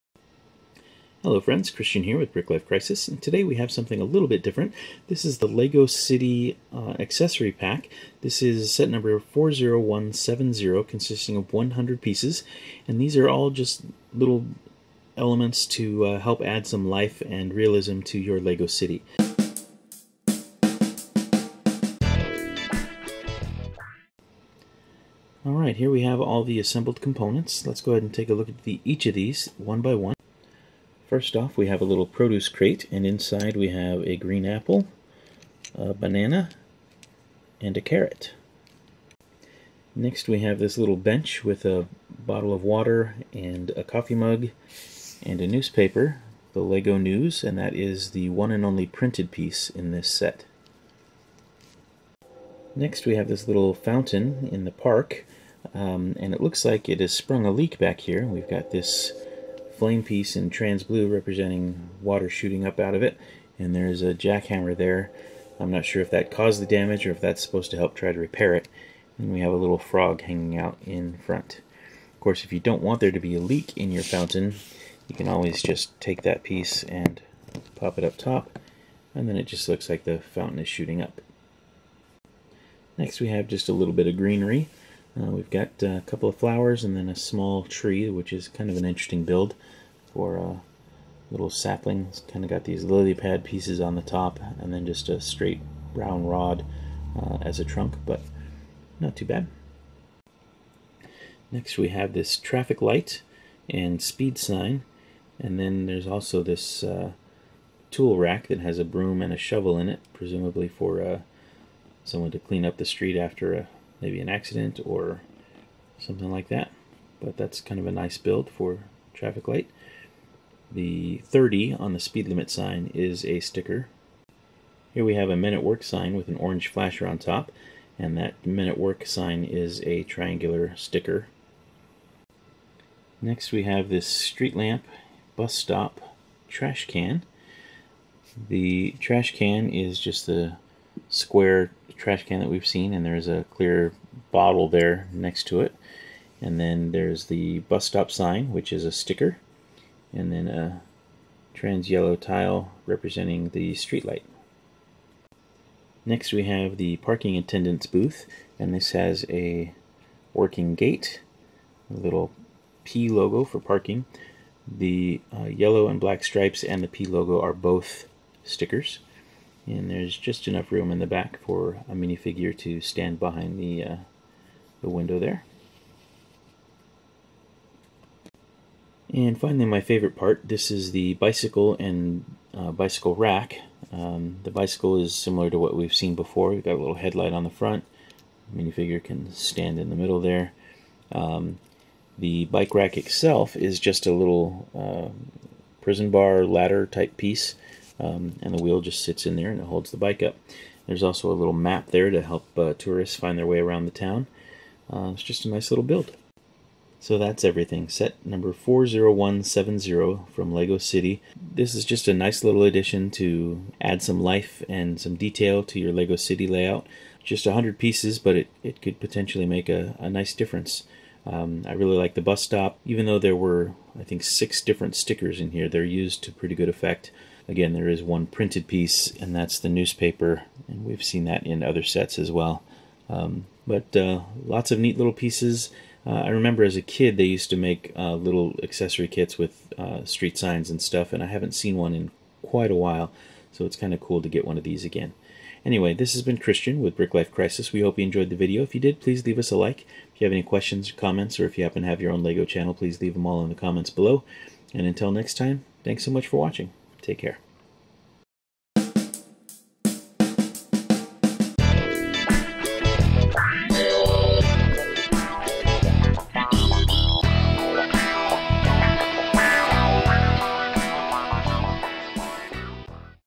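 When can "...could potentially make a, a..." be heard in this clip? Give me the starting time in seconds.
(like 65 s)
218 s.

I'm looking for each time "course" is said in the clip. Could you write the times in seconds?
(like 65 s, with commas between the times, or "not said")
72 s.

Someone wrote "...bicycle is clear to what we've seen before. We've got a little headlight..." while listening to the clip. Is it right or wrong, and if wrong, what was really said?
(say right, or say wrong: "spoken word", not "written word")
wrong: "similar", not "clear".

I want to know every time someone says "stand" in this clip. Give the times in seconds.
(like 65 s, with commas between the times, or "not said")
172 s, 189 s.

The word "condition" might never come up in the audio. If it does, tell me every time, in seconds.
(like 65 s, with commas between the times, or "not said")
not said.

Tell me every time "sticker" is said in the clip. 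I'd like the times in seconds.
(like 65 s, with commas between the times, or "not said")
123 s, 130 s, 148 s, 168 s, 224 s.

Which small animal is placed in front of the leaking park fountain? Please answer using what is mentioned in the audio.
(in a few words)
frog.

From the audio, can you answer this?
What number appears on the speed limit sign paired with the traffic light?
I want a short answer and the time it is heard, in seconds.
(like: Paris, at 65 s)
30, at 121 s.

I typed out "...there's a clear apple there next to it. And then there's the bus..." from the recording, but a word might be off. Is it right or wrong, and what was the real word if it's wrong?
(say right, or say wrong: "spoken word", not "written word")
wrong: "bottle", not "apple".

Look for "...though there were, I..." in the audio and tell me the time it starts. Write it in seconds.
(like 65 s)
223 s.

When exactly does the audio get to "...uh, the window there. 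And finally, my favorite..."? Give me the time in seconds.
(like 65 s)
173 s.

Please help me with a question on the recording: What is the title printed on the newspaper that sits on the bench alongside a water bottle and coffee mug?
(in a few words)
Lego News.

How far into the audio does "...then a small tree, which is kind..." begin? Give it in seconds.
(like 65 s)
86 s.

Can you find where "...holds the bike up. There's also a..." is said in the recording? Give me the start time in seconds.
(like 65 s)
199 s.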